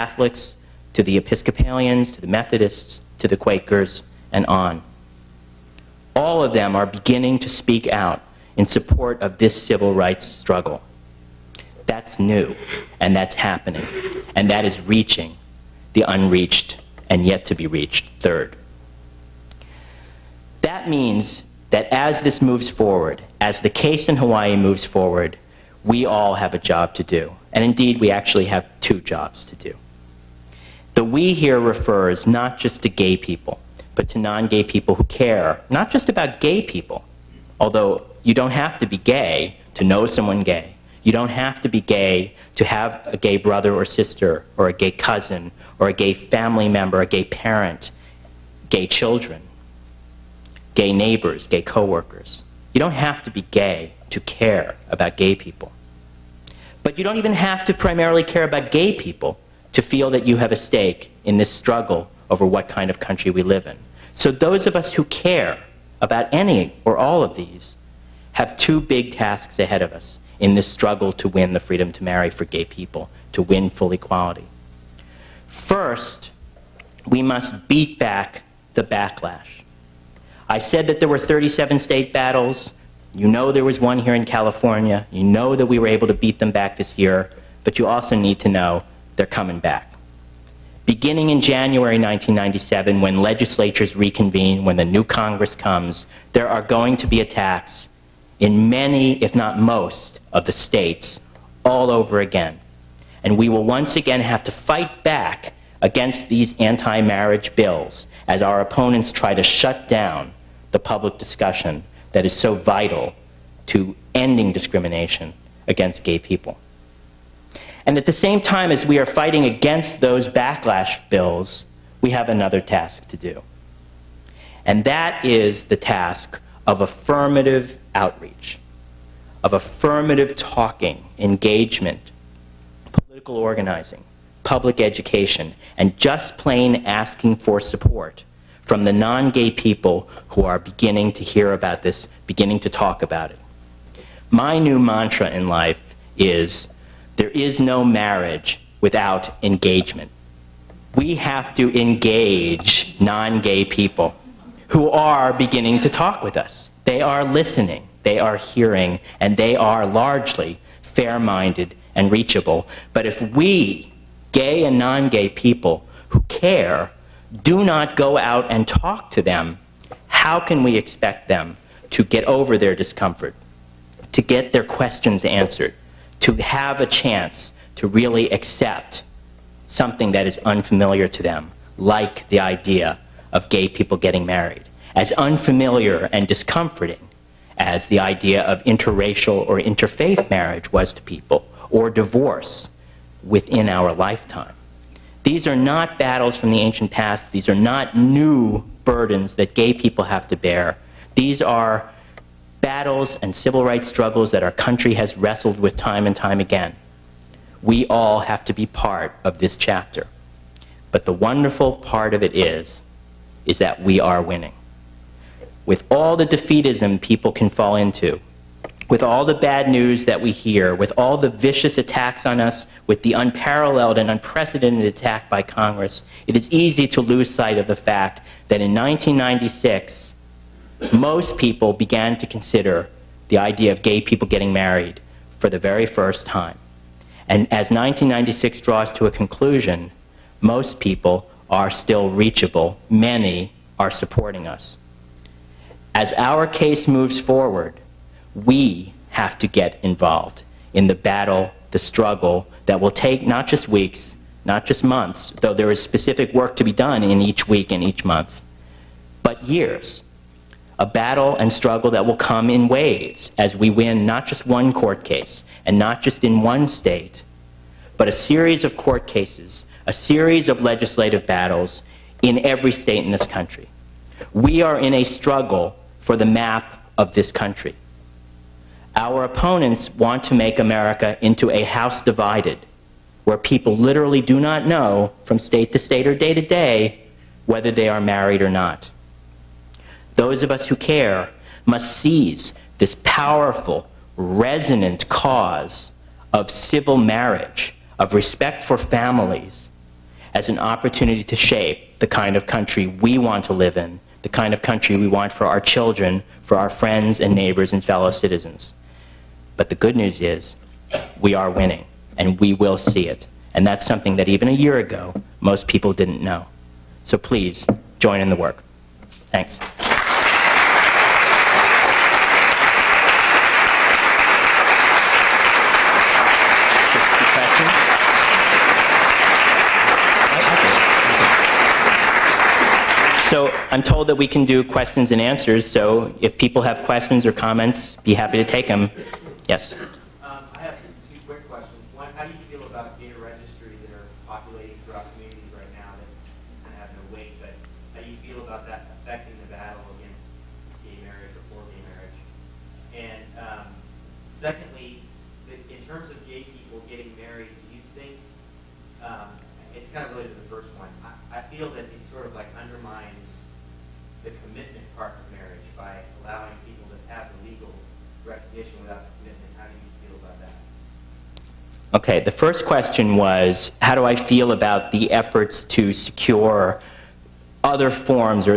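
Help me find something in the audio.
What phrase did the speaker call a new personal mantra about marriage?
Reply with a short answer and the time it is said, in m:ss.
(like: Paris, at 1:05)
There is no marriage without engagement, at 2:27.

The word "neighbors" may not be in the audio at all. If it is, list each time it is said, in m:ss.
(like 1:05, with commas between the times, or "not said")
0:50, 5:07.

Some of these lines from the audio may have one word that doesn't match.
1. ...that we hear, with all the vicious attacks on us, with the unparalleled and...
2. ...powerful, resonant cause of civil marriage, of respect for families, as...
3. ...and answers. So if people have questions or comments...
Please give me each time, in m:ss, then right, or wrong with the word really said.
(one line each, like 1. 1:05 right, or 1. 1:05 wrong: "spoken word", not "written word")
1. 3:40 right
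2. 4:53 right
3. 5:35 right.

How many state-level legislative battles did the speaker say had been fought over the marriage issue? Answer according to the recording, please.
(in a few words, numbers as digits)
37.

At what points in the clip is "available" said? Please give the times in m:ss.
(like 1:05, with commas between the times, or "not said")
not said.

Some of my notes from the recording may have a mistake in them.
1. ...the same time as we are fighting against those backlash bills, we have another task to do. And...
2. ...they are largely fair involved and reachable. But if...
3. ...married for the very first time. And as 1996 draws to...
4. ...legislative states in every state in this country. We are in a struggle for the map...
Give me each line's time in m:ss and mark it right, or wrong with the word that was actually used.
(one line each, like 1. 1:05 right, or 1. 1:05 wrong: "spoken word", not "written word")
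1. 1:58 right
2. 2:39 wrong: "minded", not "involved"
3. 3:54 right
4. 4:30 wrong: "battles", not "states".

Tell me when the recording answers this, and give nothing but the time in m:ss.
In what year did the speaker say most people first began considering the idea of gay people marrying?
3:48.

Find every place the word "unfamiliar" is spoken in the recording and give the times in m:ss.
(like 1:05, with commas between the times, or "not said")
3:00, 3:05.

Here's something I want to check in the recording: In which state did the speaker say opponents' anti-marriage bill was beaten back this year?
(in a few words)
California.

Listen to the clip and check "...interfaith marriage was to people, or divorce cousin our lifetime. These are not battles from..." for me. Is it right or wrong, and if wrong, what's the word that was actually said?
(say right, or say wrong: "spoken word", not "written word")
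wrong: "within", not "cousin".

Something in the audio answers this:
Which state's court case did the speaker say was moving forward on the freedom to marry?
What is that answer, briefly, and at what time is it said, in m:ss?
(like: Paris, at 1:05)
Hawaii, at 0:24.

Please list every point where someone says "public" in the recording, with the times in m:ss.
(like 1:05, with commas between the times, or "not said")
1:50, 2:14.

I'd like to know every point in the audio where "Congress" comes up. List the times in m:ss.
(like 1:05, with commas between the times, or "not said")
1:35, 3:45.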